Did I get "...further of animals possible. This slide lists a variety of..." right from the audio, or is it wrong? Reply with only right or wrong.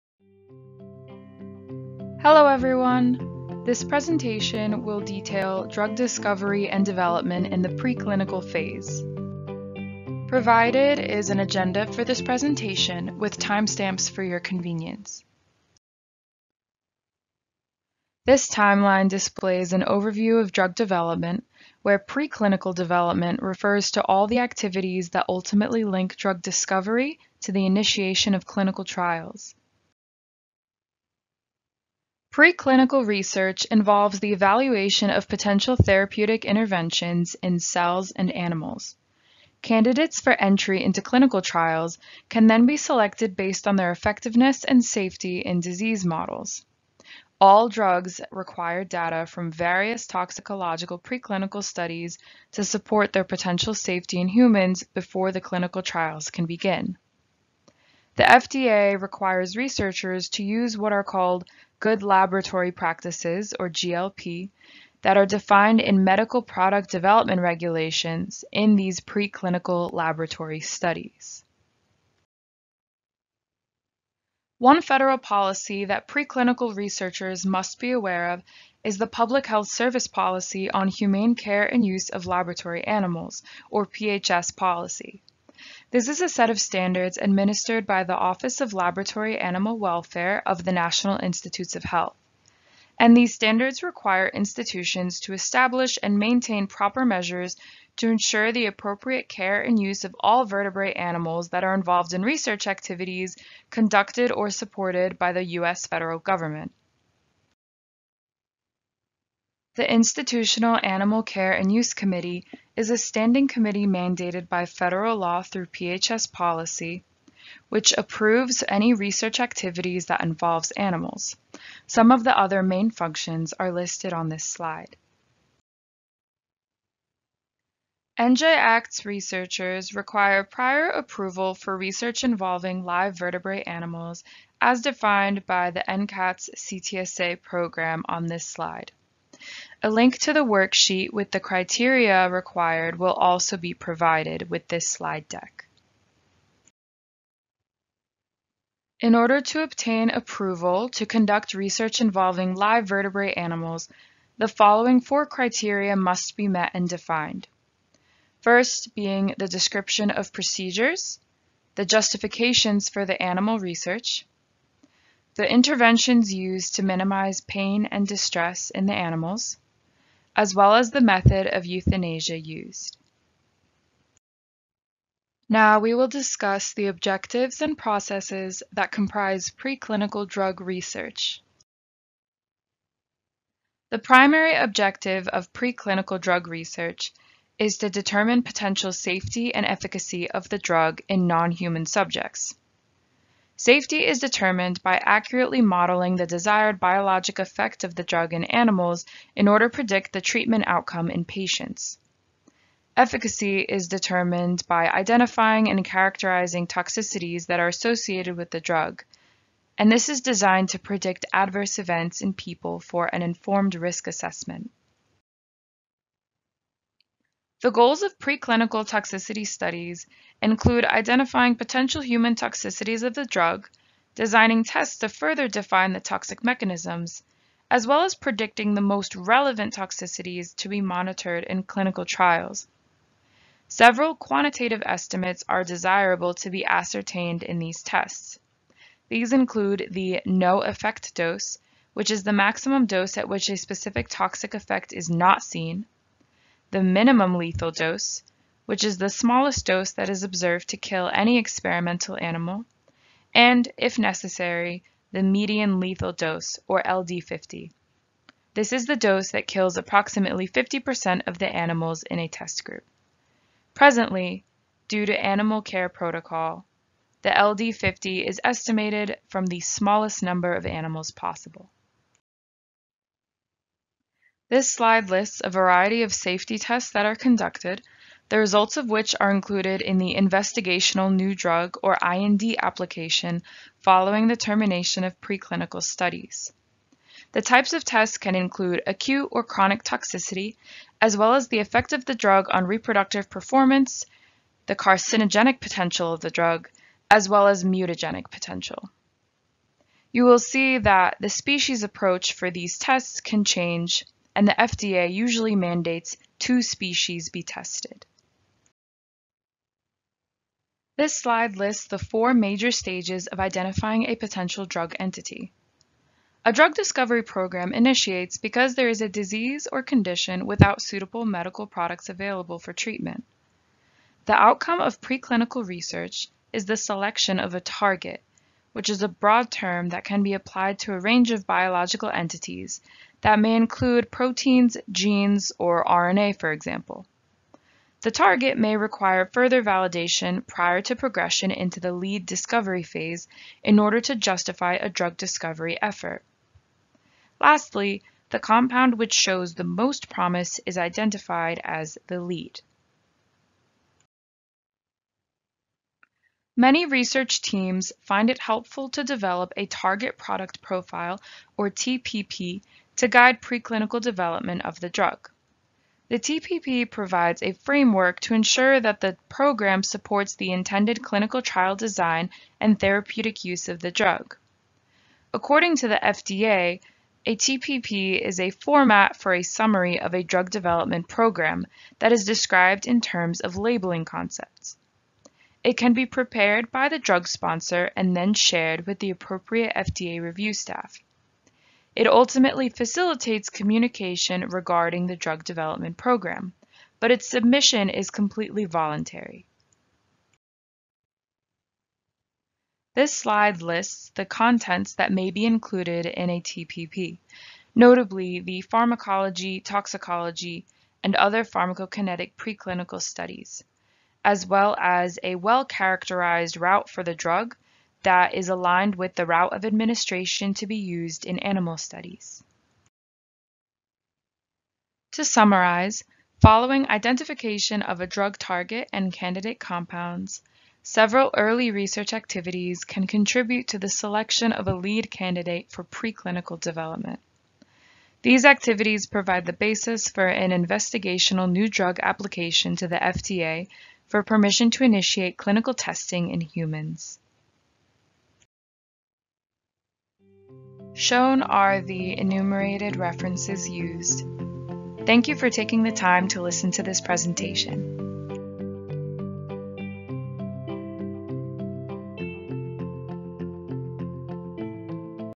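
wrong.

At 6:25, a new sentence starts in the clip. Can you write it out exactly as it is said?
It can be prepared by the drug sponsor and then shared with the appropriate FDA review staff.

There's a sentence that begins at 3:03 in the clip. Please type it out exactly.
The primary objective of preclinical drug research is to determine potential safety and efficacy of the drug in non-human subjects.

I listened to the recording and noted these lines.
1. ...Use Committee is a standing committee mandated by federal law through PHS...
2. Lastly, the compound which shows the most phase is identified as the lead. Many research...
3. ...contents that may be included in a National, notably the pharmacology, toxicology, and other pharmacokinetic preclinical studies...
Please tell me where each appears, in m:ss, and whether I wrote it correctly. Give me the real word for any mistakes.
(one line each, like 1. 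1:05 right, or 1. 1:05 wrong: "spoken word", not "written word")
1. 1:51 right
2. 5:47 wrong: "promise", not "phase"
3. 6:44 wrong: "TPP", not "National".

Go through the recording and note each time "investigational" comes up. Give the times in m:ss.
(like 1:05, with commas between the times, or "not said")
4:40, 7:20.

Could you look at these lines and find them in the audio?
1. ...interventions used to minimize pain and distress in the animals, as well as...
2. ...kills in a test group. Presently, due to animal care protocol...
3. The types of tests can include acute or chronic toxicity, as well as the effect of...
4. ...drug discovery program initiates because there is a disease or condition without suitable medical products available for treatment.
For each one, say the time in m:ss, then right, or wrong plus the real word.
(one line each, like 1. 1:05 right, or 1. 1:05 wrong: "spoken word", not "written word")
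1. 2:45 right
2. 4:21 wrong: "animals", not "kills"
3. 4:47 right
4. 5:16 right.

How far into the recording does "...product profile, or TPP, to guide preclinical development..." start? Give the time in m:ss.
6:00.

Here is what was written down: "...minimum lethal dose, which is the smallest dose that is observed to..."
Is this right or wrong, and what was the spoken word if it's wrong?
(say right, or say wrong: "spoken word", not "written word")
right.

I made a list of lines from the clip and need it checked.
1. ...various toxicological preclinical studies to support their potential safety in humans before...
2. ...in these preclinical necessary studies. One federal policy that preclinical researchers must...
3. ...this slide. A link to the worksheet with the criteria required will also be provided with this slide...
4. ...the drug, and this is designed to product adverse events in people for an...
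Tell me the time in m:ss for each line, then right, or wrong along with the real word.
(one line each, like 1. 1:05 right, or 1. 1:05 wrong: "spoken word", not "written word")
1. 0:49 right
2. 1:08 wrong: "laboratory", not "necessary"
3. 2:18 right
4. 3:28 wrong: "predict", not "product".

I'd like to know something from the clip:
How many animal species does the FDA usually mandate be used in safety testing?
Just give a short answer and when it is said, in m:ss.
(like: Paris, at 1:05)
2, at 5:06.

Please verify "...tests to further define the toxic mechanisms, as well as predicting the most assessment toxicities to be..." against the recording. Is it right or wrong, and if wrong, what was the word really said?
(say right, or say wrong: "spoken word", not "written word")
wrong: "relevant", not "assessment".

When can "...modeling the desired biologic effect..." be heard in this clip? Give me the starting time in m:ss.
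3:15.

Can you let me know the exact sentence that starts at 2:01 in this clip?
Some of the other main functions are listed on this slide.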